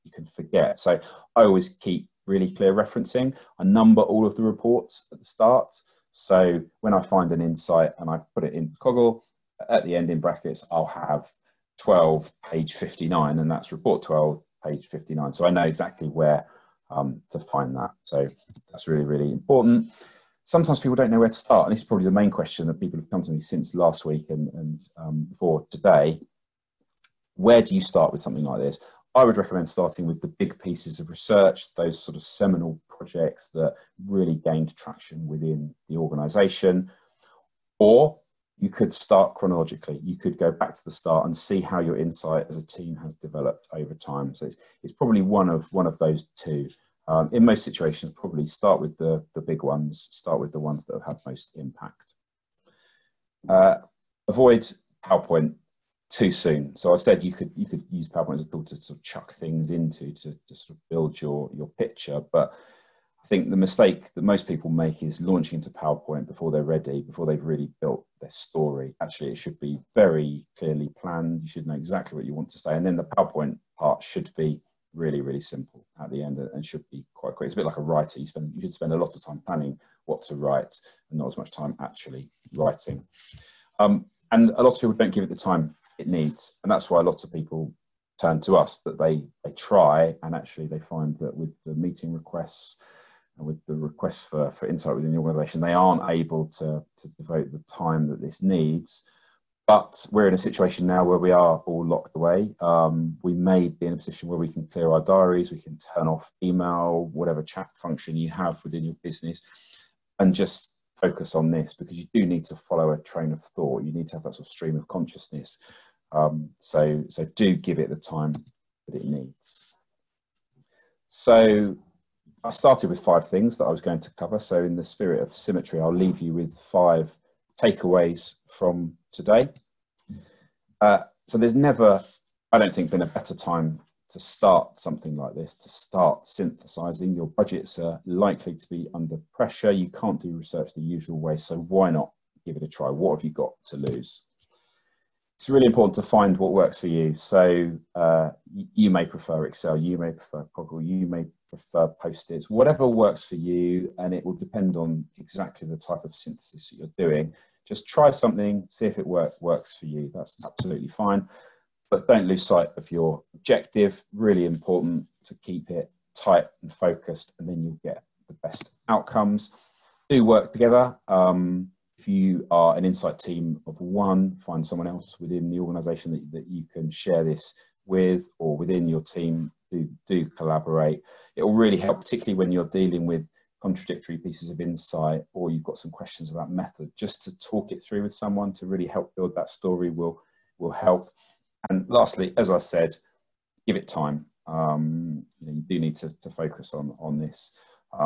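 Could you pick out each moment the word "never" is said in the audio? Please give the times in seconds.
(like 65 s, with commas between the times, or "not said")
131 s.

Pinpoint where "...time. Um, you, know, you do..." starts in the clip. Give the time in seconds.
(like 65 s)
193 s.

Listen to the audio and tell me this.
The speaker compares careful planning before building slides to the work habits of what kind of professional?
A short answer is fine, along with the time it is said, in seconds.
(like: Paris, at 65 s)
A writer, at 77 s.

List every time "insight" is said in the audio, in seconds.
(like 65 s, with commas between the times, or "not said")
7 s, 41 s, 94 s, 172 s, 184 s.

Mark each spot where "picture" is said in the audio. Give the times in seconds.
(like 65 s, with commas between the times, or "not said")
61 s.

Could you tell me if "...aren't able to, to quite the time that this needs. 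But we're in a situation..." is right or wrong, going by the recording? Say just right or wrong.
wrong.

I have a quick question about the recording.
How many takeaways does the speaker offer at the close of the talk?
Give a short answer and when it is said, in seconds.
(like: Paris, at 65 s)
5, at 126 s.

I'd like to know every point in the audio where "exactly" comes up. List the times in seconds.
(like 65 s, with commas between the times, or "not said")
15 s, 71 s, 155 s.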